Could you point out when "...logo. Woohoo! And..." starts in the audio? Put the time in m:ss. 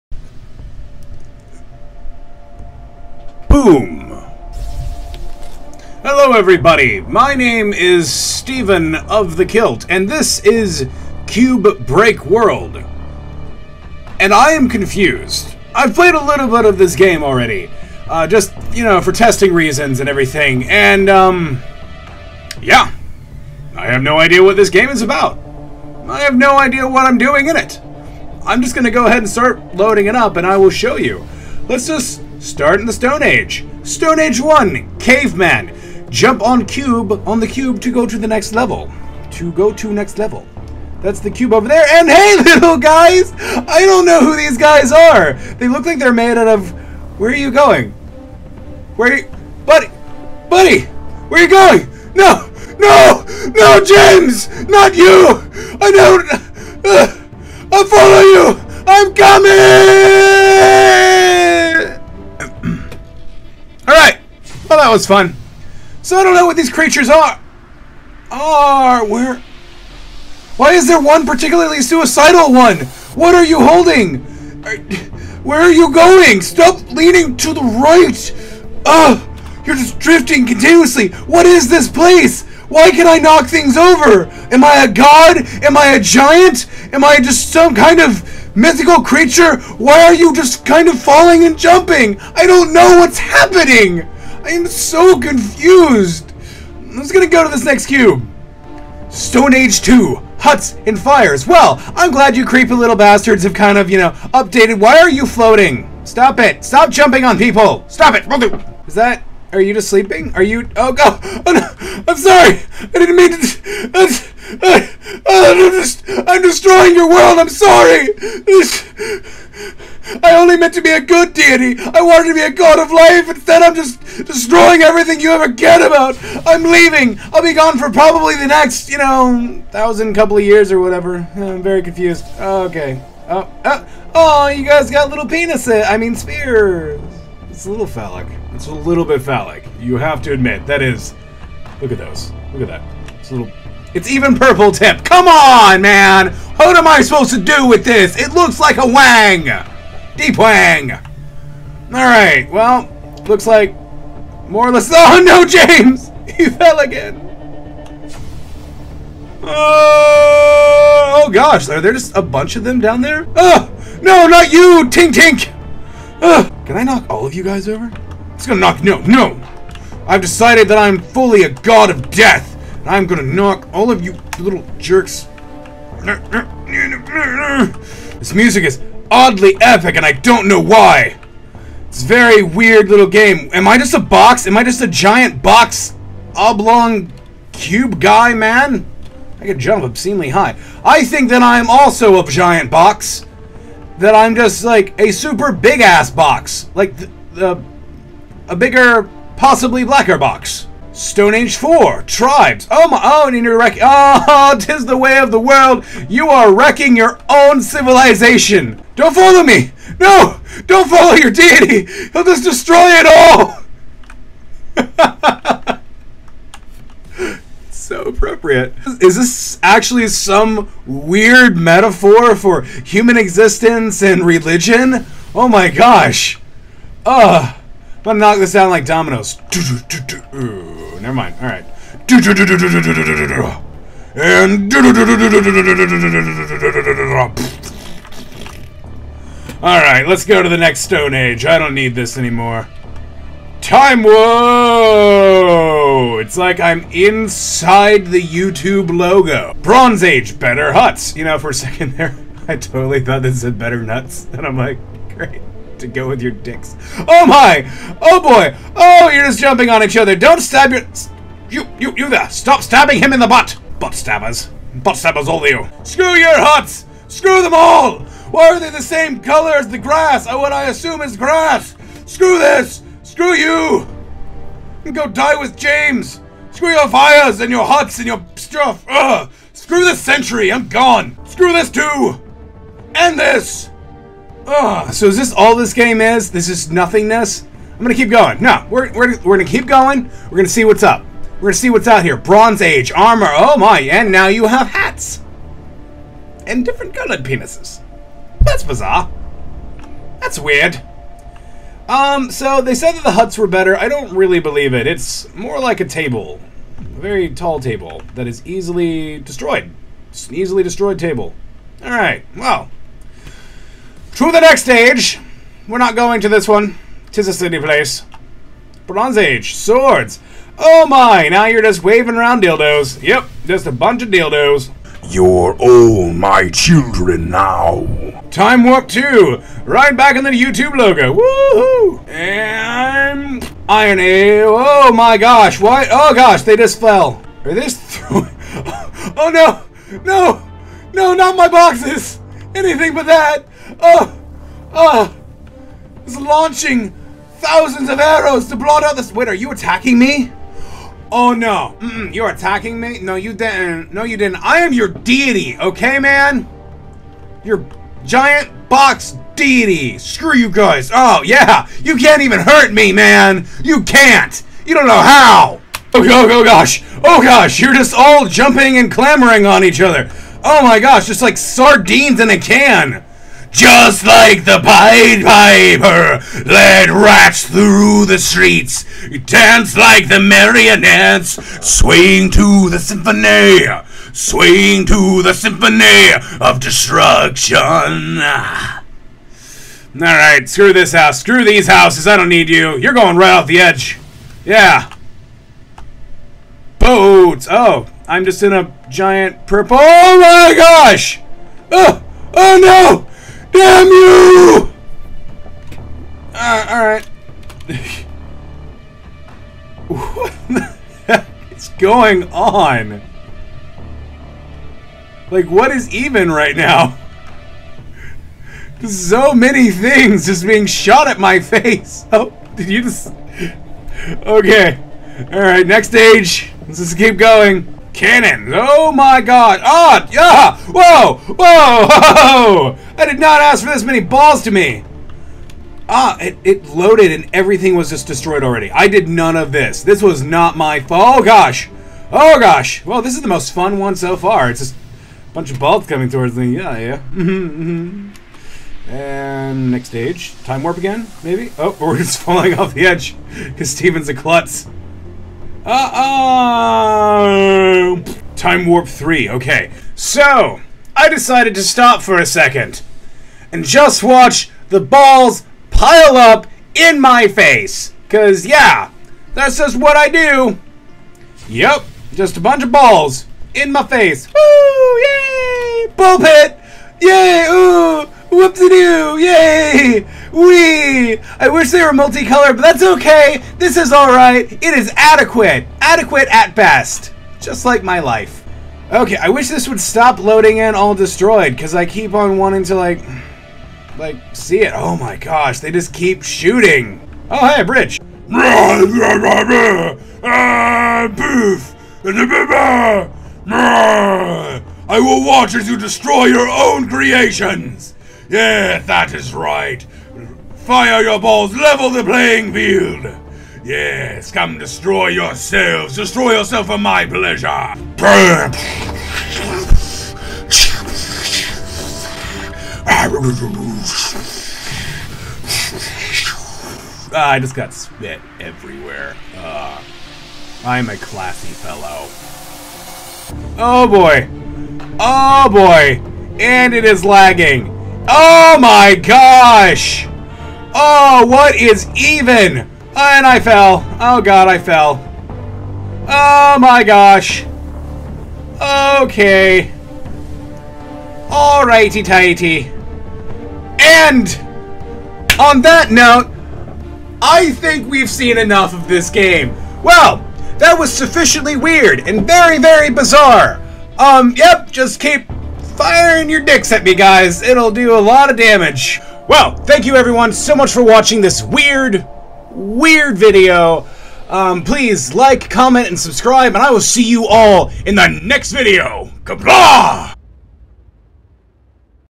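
5:30.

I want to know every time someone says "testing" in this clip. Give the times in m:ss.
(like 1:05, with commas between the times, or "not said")
0:19.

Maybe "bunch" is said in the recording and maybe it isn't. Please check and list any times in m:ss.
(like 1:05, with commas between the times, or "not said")
2:42, 5:23, 7:25, 7:52.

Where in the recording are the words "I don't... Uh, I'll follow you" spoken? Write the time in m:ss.
0:55.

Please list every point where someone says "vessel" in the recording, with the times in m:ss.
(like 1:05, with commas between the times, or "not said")
not said.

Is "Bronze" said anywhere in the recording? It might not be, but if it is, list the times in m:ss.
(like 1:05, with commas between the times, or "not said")
4:09, 4:52, 5:18.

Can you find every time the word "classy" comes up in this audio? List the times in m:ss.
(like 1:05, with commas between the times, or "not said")
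8:50.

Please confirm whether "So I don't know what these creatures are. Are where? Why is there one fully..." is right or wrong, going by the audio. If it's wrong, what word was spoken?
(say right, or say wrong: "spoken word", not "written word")
wrong: "particularly", not "fully".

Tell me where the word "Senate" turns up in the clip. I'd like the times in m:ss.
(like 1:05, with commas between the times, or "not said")
not said.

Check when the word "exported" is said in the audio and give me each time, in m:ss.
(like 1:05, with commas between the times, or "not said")
not said.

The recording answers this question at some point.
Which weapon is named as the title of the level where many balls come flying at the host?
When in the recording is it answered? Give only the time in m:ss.
7:07.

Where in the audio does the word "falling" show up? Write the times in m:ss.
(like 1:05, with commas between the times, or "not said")
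1:30, 7:32.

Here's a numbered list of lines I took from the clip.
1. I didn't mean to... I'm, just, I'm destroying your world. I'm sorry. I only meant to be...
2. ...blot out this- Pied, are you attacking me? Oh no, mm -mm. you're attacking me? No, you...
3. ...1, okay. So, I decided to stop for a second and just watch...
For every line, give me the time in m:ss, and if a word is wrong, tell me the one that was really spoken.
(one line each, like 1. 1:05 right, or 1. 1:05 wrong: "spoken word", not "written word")
1. 1:52 right
2. 5:48 wrong: "Wait", not "Pied"
3. 7:38 wrong: "3", not "1".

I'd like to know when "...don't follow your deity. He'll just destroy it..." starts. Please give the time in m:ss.
3:30.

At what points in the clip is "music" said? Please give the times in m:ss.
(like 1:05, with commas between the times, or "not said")
2:58.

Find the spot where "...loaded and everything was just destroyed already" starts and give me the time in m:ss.
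7:16.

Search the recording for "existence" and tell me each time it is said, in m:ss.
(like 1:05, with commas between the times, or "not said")
3:43.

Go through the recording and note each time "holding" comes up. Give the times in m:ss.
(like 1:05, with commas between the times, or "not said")
1:13.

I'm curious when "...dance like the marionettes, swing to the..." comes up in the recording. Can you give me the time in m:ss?
6:19.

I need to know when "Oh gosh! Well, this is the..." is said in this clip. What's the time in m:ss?
7:22.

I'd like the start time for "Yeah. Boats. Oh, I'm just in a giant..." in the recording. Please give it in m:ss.
6:34.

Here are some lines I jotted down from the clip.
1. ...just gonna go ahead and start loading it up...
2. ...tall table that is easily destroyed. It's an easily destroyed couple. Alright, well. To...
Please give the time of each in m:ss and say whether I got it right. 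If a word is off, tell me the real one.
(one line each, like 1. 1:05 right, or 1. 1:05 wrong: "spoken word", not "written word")
1. 0:28 right
2. 5:07 wrong: "table", not "couple".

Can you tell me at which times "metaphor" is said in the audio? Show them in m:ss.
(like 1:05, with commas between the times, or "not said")
3:41.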